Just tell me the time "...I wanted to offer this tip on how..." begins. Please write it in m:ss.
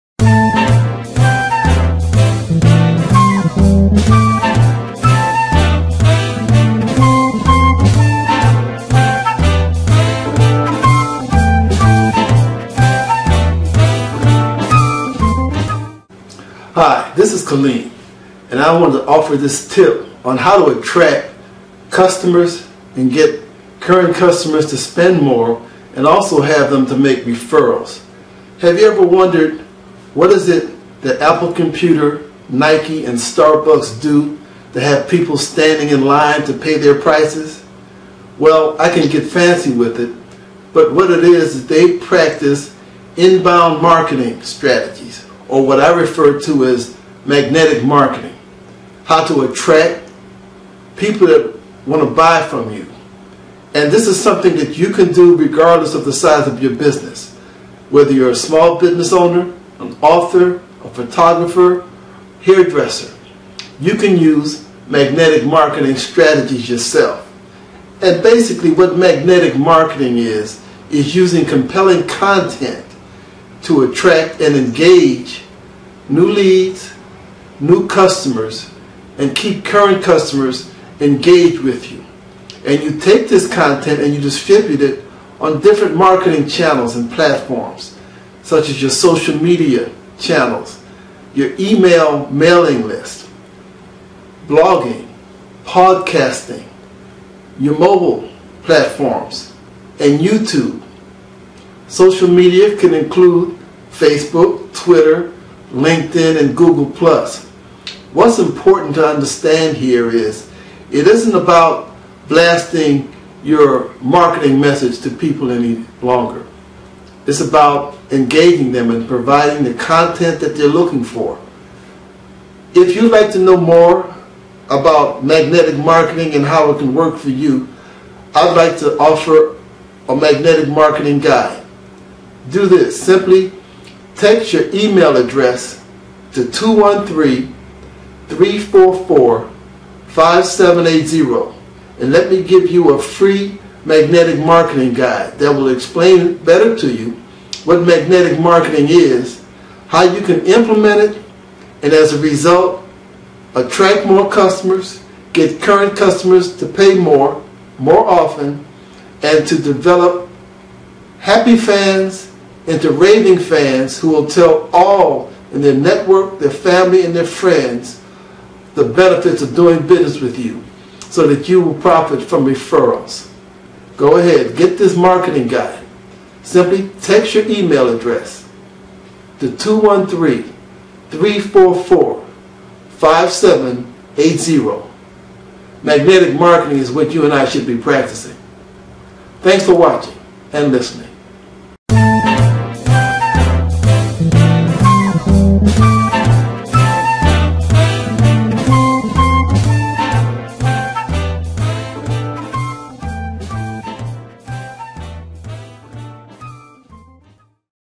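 0:18.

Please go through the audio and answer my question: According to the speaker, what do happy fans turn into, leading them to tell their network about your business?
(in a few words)
Raving fans.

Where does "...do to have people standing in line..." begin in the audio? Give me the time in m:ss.
0:34.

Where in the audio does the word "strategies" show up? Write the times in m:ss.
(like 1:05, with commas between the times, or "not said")
0:44, 1:05.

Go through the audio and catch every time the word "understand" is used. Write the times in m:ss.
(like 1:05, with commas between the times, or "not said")
1:49.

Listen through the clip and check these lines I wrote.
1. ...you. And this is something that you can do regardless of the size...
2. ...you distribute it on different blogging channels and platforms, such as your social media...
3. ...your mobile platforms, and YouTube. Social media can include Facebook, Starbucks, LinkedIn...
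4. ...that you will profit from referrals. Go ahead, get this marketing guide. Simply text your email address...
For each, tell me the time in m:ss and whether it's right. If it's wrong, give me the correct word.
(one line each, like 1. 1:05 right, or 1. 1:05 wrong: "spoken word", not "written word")
1. 0:52 right
2. 1:24 wrong: "marketing", not "blogging"
3. 1:37 wrong: "Twitter", not "Starbucks"
4. 2:51 right.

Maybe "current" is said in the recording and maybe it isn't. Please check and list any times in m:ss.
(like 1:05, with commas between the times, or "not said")
0:23, 1:19, 2:35.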